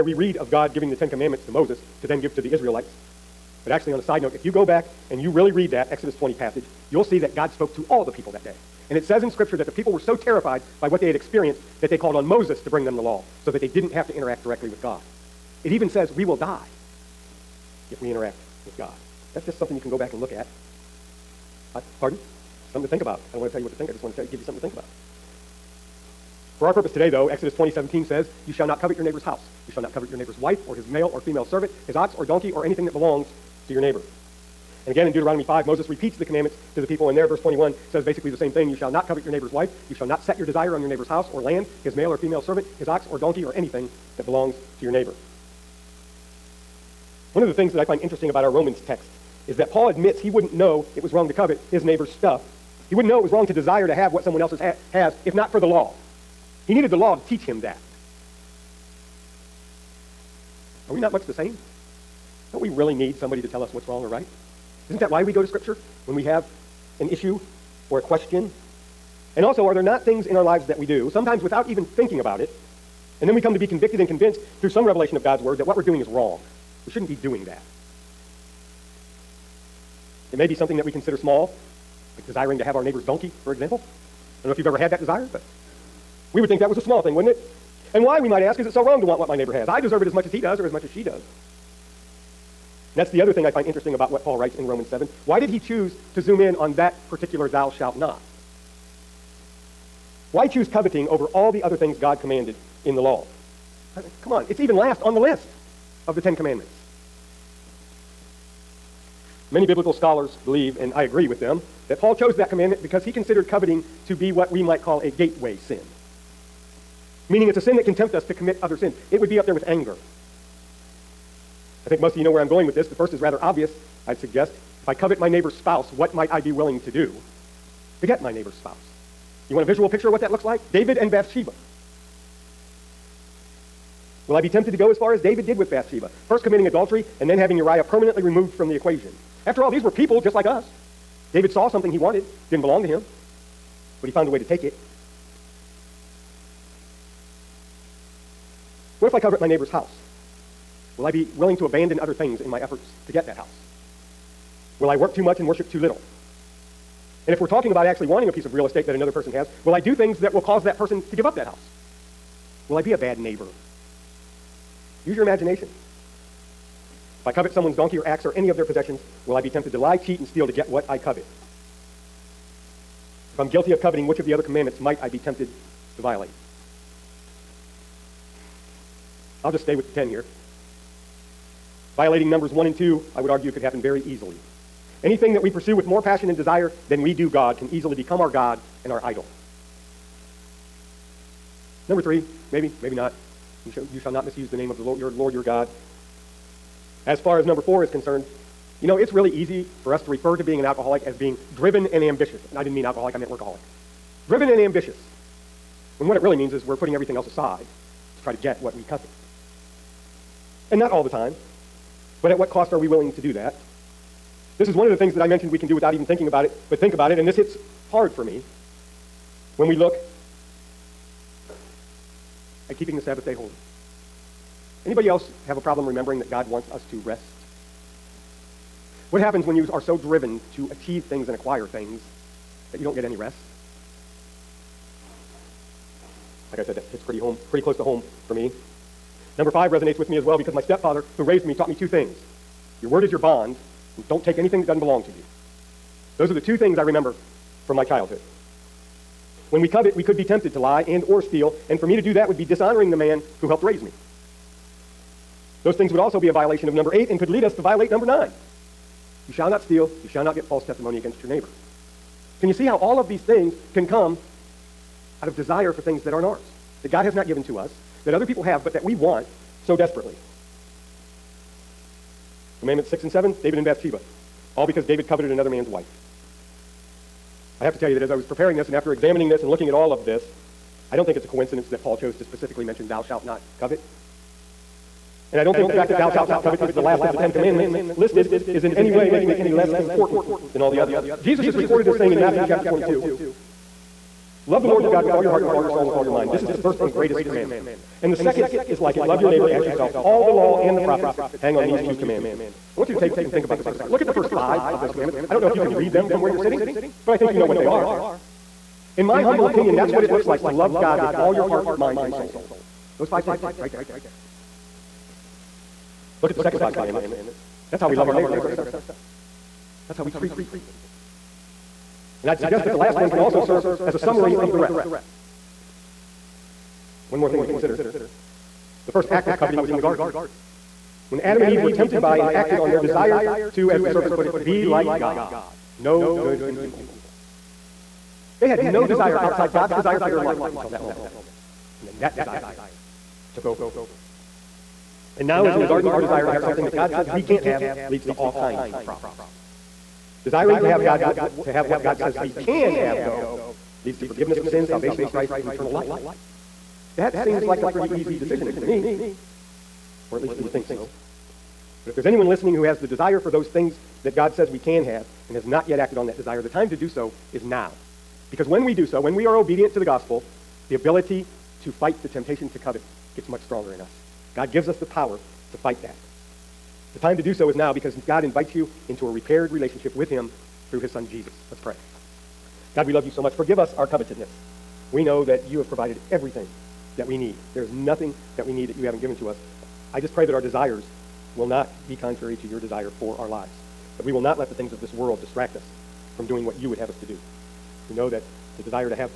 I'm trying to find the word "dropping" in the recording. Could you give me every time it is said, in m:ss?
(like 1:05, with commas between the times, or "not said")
not said.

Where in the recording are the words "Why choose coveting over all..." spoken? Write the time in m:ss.
1:40.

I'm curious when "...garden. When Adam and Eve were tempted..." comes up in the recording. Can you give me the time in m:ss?
5:29.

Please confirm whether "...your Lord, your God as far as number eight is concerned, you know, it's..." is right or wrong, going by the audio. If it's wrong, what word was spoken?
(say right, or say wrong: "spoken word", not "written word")
wrong: "four", not "eight".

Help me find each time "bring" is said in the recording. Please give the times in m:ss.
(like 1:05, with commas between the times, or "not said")
0:12.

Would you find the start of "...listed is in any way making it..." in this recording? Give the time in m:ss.
4:47.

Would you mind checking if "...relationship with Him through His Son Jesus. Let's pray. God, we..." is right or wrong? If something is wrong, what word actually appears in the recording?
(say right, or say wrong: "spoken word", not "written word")
right.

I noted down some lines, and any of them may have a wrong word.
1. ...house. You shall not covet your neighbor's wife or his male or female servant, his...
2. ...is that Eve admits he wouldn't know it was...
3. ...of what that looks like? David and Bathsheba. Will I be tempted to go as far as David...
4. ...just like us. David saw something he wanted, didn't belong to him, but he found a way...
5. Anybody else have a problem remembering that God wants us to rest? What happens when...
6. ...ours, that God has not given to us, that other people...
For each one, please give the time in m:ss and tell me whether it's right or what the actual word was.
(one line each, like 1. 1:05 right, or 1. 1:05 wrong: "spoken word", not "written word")
1. 0:29 right
2. 0:49 wrong: "Paul", not "Eve"
3. 2:10 right
4. 2:20 right
5. 3:44 right
6. 4:26 right.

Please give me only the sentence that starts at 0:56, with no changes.
He needed the law to teach him that.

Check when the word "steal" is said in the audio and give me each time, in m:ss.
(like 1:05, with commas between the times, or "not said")
2:50, 4:11, 4:19.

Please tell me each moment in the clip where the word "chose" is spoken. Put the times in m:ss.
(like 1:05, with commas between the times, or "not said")
1:52, 4:41.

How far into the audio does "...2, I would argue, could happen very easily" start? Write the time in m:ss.
3:02.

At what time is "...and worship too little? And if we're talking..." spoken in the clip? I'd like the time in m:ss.
2:35.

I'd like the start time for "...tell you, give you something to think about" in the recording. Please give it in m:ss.
0:24.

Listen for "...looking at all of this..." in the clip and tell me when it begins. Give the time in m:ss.
4:39.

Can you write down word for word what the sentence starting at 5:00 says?
All the law and the prophets hang on these two commandments.